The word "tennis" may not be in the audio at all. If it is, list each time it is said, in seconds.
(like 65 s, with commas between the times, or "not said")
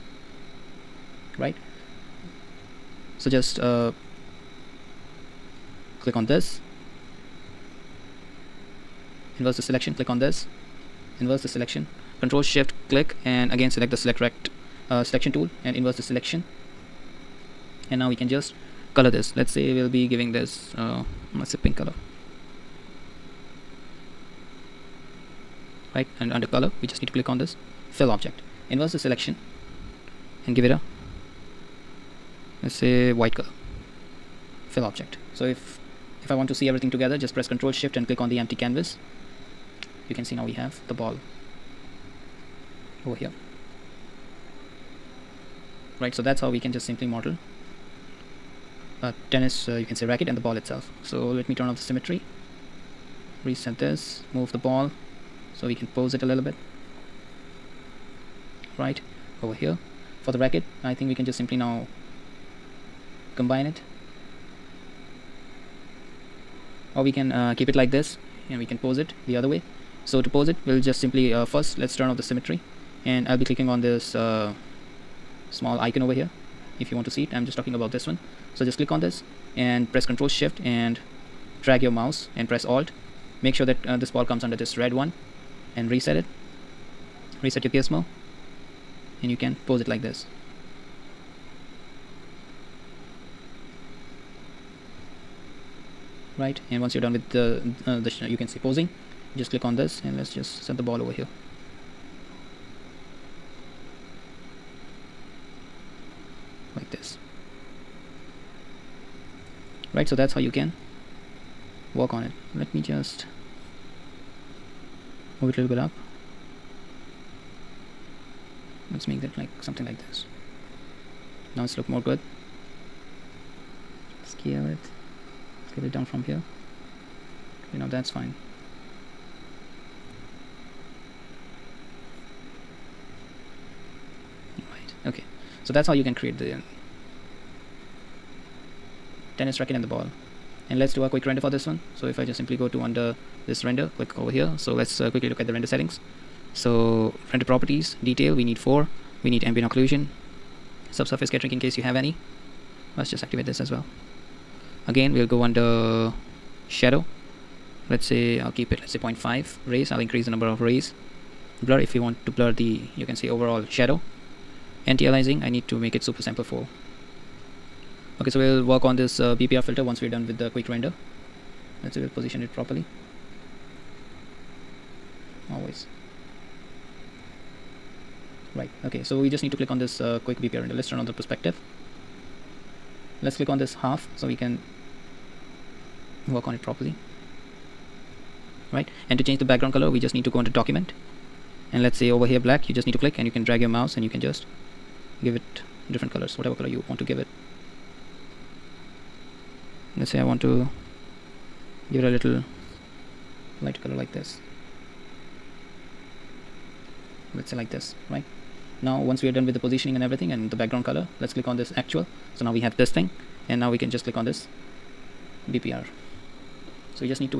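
49 s, 139 s.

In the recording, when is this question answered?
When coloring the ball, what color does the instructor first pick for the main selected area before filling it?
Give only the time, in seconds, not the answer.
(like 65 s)
21 s.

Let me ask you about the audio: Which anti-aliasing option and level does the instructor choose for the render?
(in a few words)
super sample 4.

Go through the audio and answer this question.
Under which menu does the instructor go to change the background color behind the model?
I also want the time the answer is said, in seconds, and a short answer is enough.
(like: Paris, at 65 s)
document, at 190 s.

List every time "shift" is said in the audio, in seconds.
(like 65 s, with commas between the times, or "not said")
12 s, 37 s, 80 s.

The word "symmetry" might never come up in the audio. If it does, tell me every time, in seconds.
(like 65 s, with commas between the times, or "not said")
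51 s, 72 s.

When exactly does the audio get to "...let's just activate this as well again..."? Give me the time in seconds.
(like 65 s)
152 s.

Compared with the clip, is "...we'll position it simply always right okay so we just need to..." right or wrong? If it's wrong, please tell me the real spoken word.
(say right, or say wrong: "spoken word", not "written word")
wrong: "properly", not "simply".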